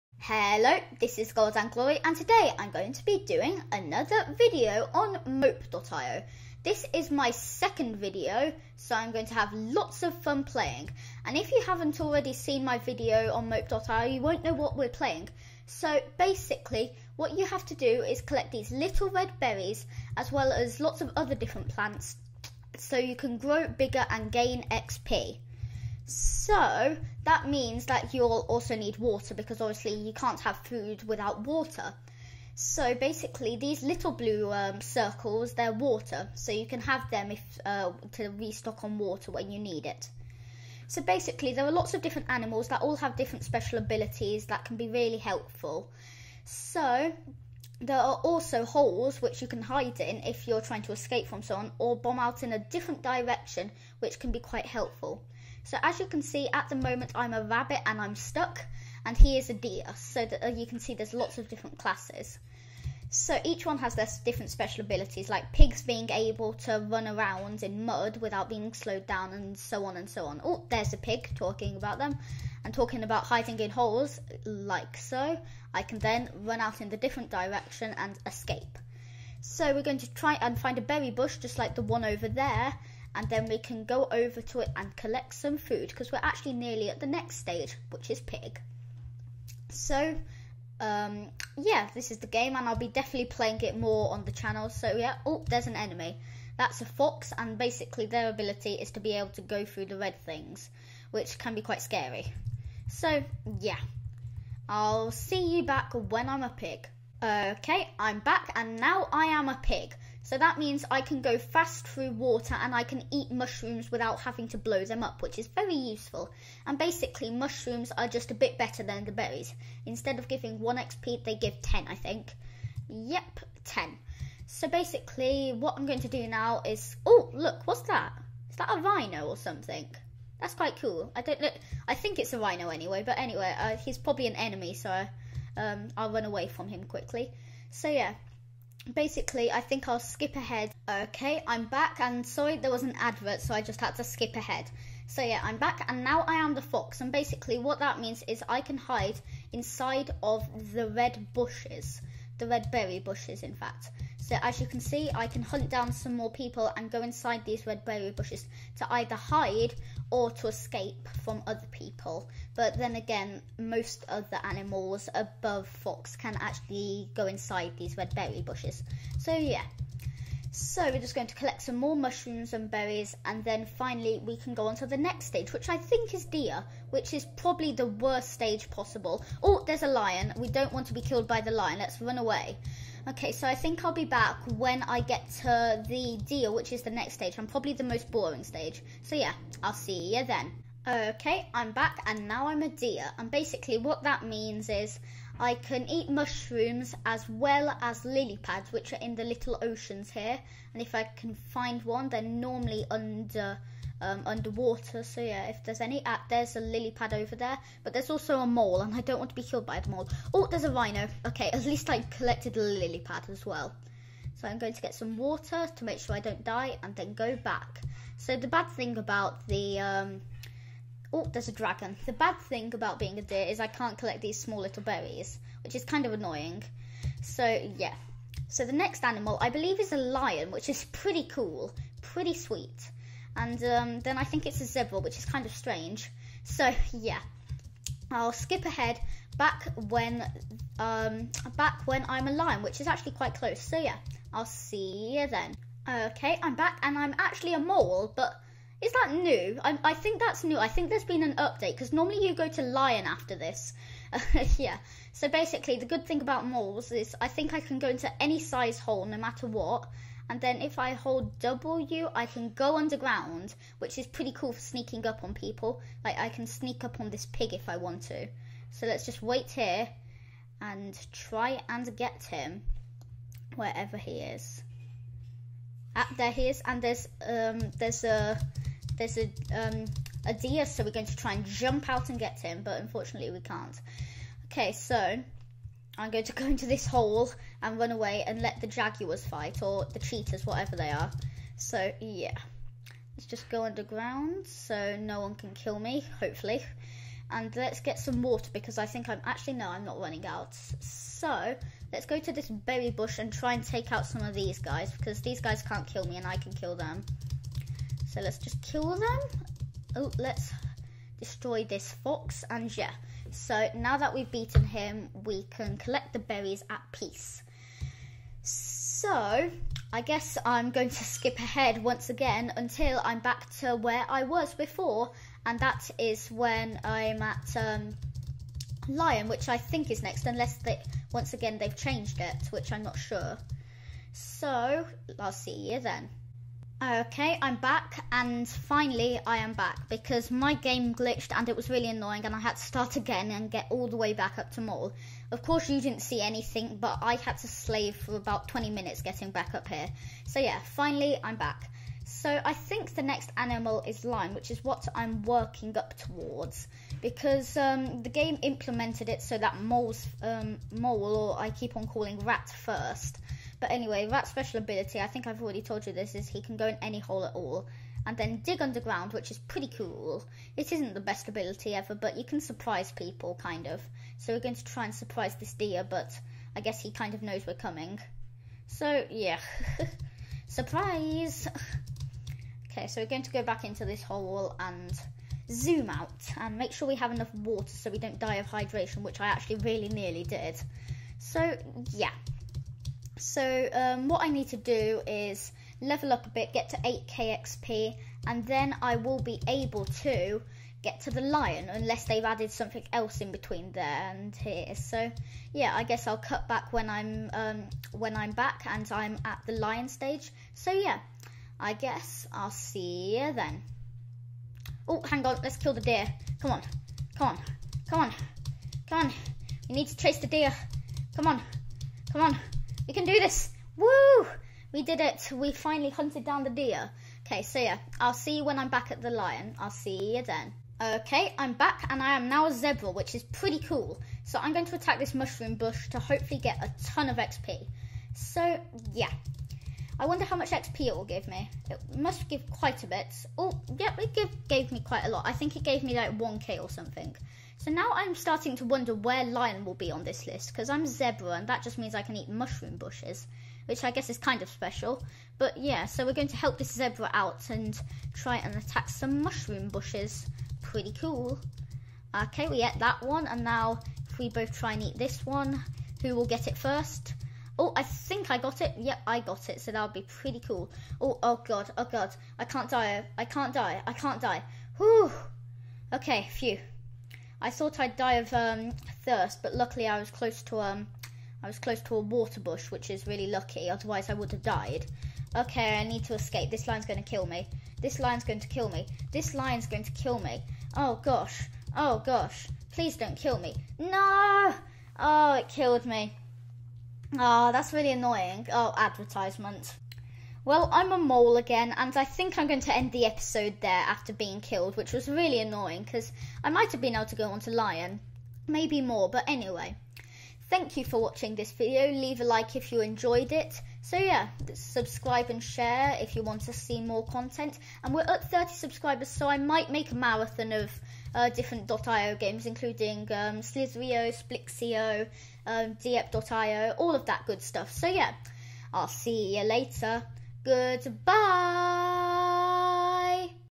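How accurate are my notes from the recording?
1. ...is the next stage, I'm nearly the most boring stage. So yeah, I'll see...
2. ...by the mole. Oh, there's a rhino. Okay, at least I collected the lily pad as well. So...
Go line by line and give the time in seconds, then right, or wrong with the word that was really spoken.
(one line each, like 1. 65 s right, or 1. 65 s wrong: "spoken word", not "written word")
1. 186 s wrong: "probably", not "nearly"
2. 209 s right.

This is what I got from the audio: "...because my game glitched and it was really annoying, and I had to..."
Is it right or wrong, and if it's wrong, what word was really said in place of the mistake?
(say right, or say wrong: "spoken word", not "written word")
right.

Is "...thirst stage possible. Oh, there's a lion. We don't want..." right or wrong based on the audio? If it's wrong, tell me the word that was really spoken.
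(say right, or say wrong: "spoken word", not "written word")
wrong: "worst", not "thirst".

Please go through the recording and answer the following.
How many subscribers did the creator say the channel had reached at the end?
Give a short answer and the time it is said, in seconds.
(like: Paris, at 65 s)
30, at 518 s.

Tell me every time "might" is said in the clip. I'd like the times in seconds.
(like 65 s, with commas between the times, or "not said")
506 s, 519 s.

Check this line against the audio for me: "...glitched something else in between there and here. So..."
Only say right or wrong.
wrong.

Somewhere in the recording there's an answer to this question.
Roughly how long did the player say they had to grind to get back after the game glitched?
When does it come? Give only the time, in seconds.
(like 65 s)
348 s.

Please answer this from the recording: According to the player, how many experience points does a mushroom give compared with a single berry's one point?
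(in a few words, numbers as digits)
10.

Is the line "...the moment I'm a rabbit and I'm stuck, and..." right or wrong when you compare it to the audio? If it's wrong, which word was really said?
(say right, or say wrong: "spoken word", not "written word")
right.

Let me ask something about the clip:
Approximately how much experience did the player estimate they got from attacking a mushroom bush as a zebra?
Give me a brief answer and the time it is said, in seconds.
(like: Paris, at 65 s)
1k, at 446 s.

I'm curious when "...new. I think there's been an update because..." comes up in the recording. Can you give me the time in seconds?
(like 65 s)
250 s.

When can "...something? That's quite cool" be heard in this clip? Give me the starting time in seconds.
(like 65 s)
129 s.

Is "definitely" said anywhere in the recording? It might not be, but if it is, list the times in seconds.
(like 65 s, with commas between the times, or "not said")
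92 s.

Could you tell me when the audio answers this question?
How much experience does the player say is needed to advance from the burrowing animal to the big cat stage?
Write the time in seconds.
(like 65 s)
396 s.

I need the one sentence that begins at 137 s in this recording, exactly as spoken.
So yeah, basically I think I'll skip ahead.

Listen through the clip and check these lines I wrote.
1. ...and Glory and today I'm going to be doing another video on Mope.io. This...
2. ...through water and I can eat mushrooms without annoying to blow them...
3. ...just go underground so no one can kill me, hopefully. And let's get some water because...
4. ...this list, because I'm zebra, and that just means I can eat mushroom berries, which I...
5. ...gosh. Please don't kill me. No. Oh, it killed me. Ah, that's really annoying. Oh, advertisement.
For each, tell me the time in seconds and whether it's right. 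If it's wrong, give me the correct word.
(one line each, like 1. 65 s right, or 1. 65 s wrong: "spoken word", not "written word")
1. 1 s right
2. 111 s wrong: "having", not "annoying"
3. 293 s right
4. 450 s wrong: "bushes", not "berries"
5. 492 s right.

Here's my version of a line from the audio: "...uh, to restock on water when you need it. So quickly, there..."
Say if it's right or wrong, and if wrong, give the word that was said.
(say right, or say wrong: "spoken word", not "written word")
wrong: "basically", not "quickly".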